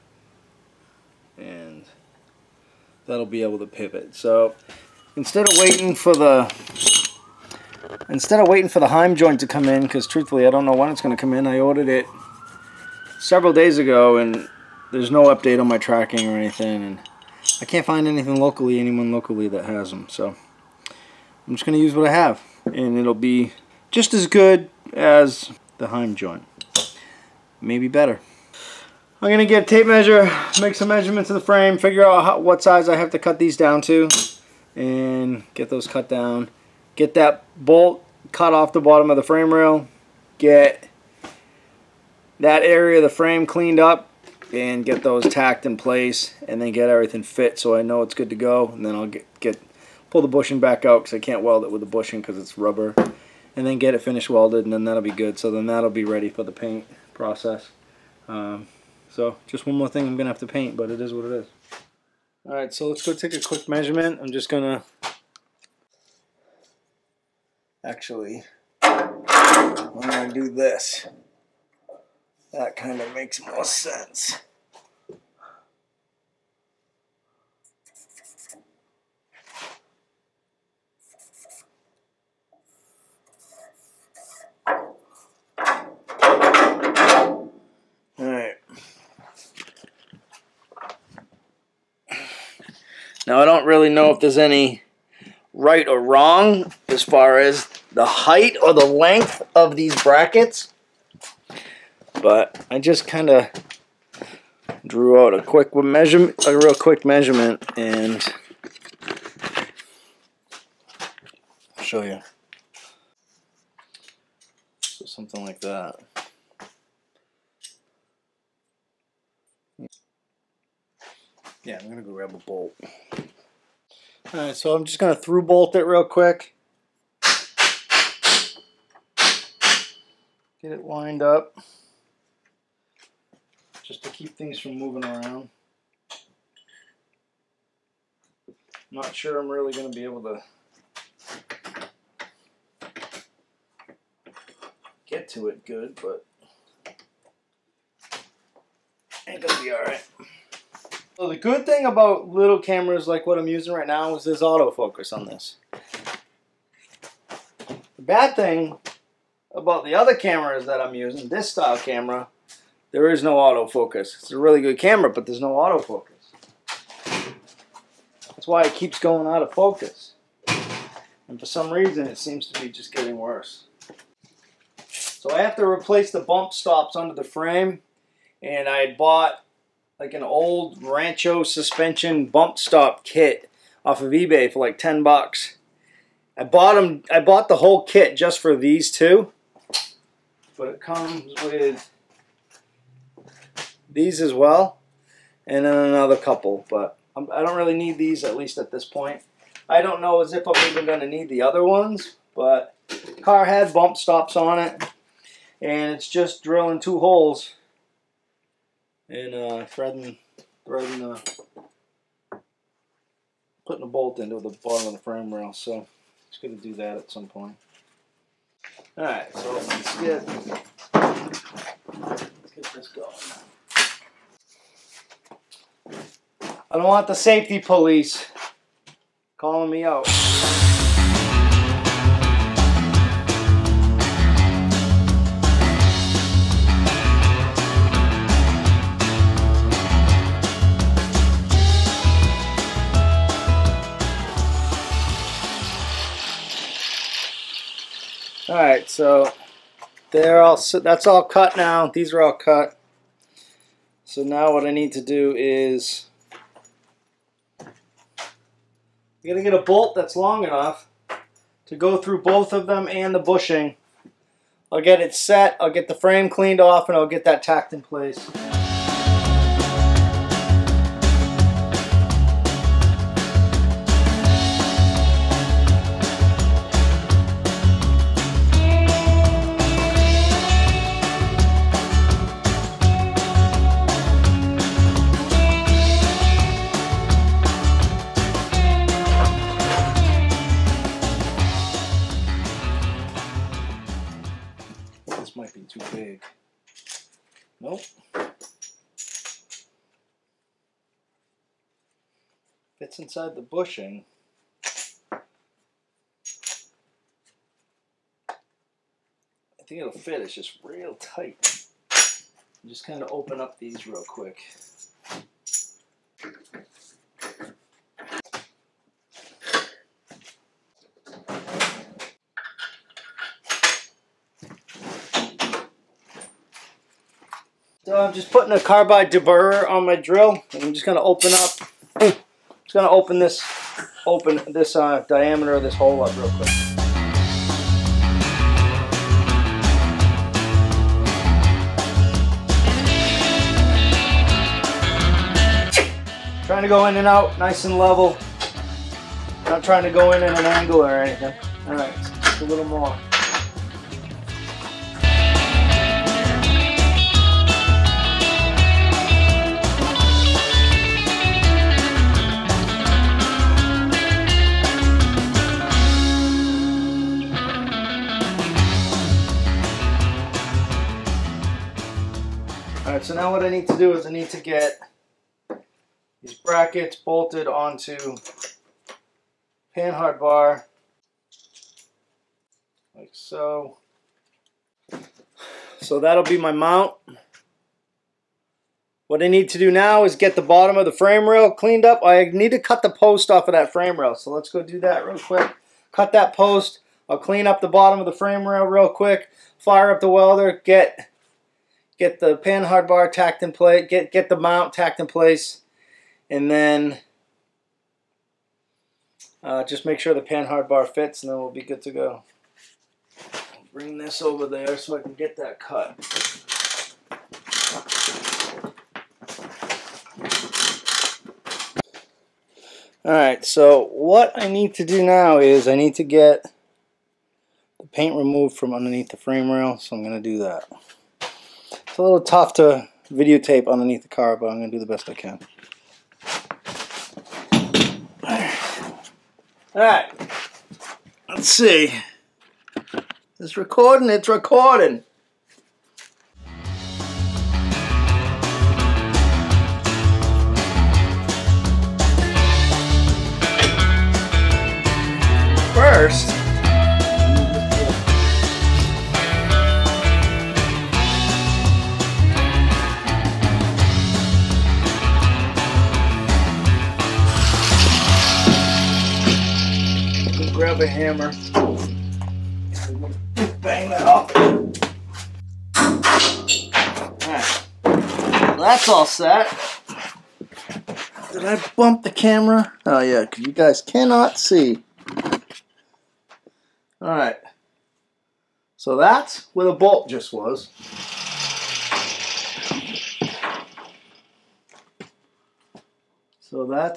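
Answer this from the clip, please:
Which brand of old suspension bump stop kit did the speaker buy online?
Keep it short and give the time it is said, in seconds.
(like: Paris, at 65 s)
Rancho, at 180 s.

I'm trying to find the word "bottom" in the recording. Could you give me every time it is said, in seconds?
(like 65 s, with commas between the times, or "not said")
38 s, 214 s, 390 s, 397 s.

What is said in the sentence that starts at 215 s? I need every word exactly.
So it's going to do that at some point.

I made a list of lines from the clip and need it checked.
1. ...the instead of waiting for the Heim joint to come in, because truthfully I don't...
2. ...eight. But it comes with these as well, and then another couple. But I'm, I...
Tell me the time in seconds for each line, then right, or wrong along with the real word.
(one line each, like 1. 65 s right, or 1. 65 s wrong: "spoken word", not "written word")
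1. 6 s right
2. 188 s wrong: "two", not "eight".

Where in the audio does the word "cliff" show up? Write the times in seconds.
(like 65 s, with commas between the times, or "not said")
not said.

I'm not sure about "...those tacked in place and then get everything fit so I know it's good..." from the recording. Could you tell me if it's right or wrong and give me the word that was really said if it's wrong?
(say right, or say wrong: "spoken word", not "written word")
right.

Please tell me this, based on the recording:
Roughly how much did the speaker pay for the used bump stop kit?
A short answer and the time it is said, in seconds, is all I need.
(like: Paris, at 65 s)
$10, at 184 s.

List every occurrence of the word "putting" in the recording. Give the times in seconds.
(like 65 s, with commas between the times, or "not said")
213 s, 328 s.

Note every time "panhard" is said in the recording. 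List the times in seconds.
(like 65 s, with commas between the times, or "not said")
379 s, 402 s, 410 s.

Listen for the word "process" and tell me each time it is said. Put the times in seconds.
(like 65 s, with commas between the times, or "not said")
57 s.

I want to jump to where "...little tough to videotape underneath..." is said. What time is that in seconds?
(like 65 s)
432 s.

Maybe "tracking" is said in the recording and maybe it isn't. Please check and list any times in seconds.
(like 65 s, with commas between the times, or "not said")
15 s.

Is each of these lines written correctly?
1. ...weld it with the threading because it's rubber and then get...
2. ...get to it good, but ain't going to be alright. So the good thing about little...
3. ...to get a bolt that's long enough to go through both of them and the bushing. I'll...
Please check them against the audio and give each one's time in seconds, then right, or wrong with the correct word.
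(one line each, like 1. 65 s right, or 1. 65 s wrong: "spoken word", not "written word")
1. 51 s wrong: "bushing", not "threading"
2. 145 s right
3. 259 s right.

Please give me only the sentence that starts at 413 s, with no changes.
Bring this over there so I can get that cut.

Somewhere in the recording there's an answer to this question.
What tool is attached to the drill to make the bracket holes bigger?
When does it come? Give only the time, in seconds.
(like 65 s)
328 s.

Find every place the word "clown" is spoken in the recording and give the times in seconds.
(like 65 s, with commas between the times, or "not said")
not said.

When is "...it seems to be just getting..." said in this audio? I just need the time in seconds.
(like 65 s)
172 s.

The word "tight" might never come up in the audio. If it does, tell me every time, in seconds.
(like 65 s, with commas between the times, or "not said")
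310 s.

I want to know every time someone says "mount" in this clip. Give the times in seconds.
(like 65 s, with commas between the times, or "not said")
386 s, 404 s.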